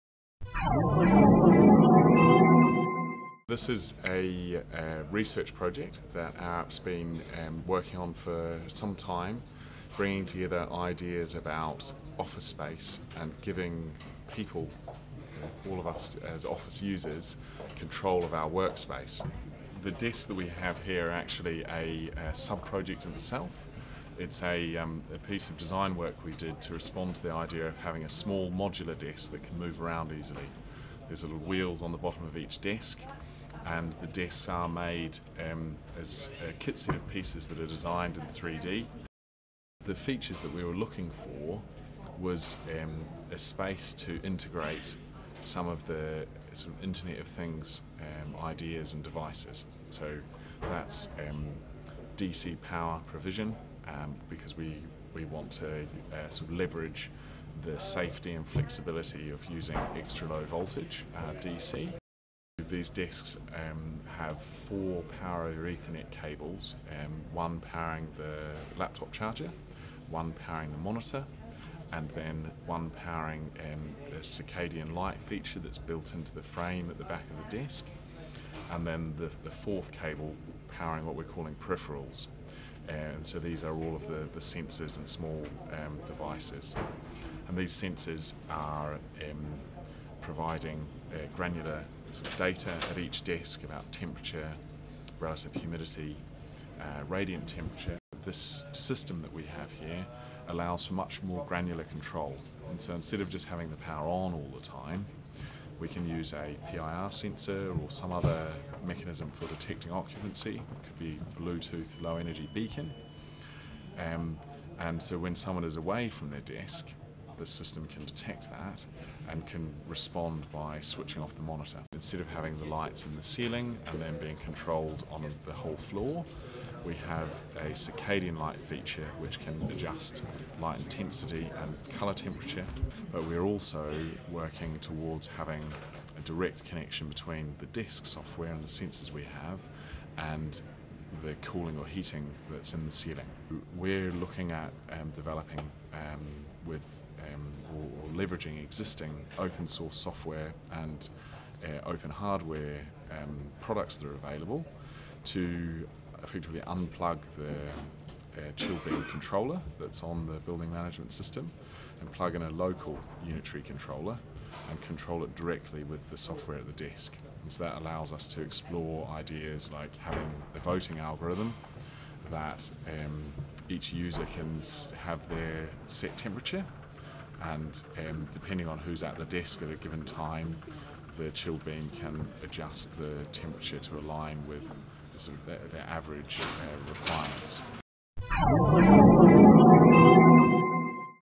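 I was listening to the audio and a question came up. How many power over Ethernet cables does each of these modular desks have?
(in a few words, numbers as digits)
4.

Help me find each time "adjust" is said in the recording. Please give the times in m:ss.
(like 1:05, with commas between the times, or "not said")
2:09, 3:02.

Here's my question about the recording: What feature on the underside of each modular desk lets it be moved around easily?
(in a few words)
little wheels.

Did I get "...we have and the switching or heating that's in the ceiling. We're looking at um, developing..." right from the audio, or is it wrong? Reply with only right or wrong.
wrong.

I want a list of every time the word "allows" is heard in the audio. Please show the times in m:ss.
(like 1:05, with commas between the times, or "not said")
1:40, 2:47.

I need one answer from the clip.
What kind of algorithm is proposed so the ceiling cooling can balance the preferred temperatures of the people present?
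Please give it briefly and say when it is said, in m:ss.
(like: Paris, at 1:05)
voting algorithm, at 2:50.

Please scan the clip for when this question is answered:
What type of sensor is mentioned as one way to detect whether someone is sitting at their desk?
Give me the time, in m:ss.
1:46.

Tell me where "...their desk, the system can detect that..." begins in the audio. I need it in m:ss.
1:56.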